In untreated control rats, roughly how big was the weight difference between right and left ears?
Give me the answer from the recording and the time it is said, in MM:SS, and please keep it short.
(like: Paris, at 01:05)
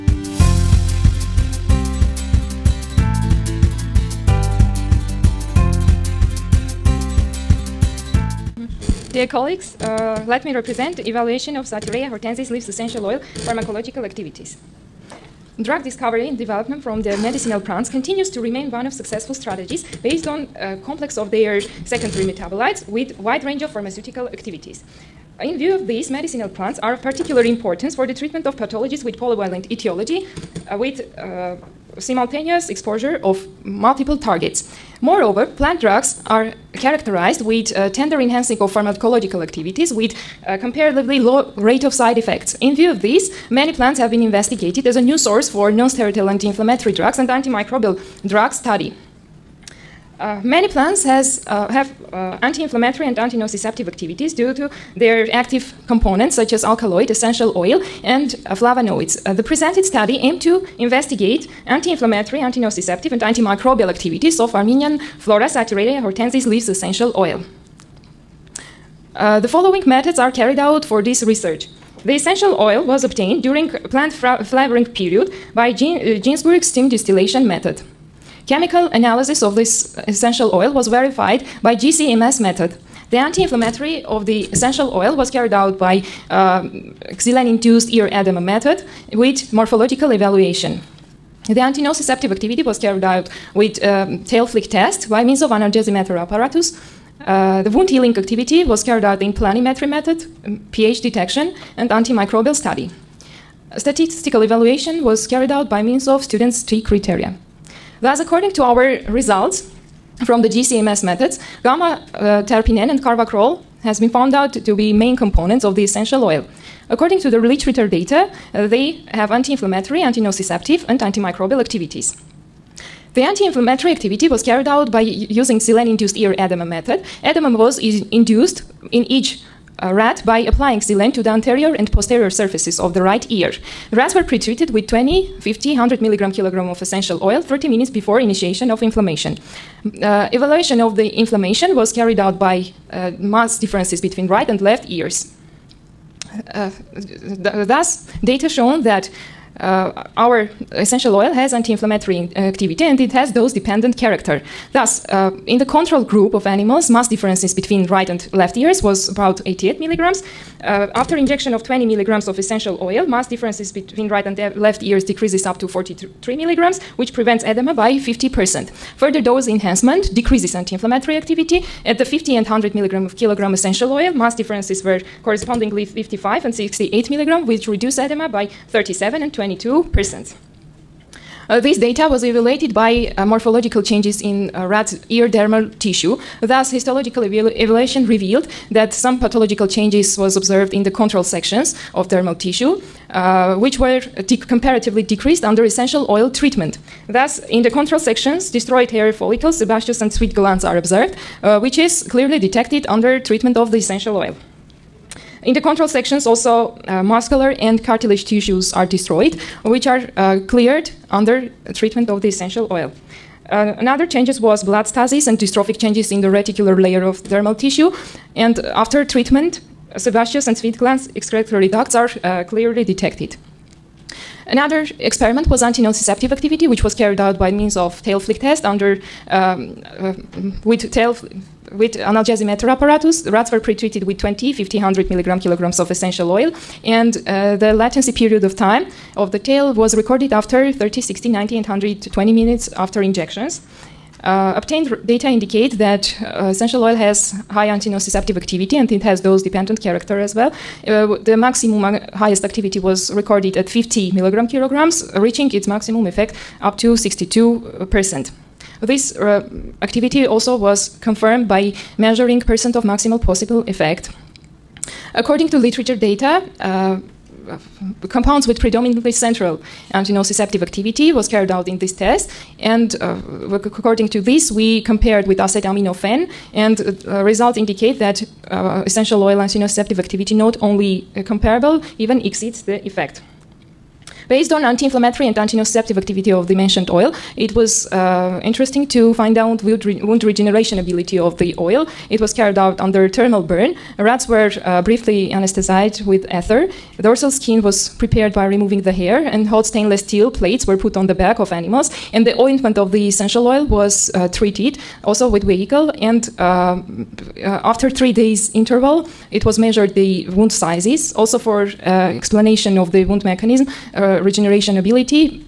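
88 milligrams, at 02:39.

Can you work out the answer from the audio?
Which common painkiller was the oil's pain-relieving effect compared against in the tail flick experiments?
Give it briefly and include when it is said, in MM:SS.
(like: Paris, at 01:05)
acetaminophen, at 04:35.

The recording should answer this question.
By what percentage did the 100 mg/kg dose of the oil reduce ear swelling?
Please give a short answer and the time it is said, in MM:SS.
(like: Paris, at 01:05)
22%, at 02:59.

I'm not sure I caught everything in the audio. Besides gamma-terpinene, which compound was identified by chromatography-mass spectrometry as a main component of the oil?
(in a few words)
carvacrol.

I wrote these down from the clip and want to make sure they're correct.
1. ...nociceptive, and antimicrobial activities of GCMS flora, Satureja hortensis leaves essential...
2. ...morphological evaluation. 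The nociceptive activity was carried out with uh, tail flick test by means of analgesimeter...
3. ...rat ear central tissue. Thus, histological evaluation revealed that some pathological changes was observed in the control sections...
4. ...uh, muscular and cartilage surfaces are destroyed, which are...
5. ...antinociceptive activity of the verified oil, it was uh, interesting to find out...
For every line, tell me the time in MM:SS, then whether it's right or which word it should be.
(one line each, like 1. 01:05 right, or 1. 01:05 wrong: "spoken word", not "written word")
1. 01:02 wrong: "Armenian", not "GCMS"
2. 01:29 wrong: "antinociceptive", not "nociceptive"
3. 03:04 wrong: "dermal", not "central"
4. 03:26 wrong: "tissues", not "surfaces"
5. 04:45 wrong: "mentioned", not "verified".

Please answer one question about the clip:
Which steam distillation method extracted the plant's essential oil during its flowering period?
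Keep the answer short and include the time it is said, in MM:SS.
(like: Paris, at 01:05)
Ginsburg, at 01:16.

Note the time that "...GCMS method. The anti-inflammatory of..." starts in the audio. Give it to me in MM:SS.
01:21.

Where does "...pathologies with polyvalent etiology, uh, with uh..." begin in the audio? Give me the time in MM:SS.
00:28.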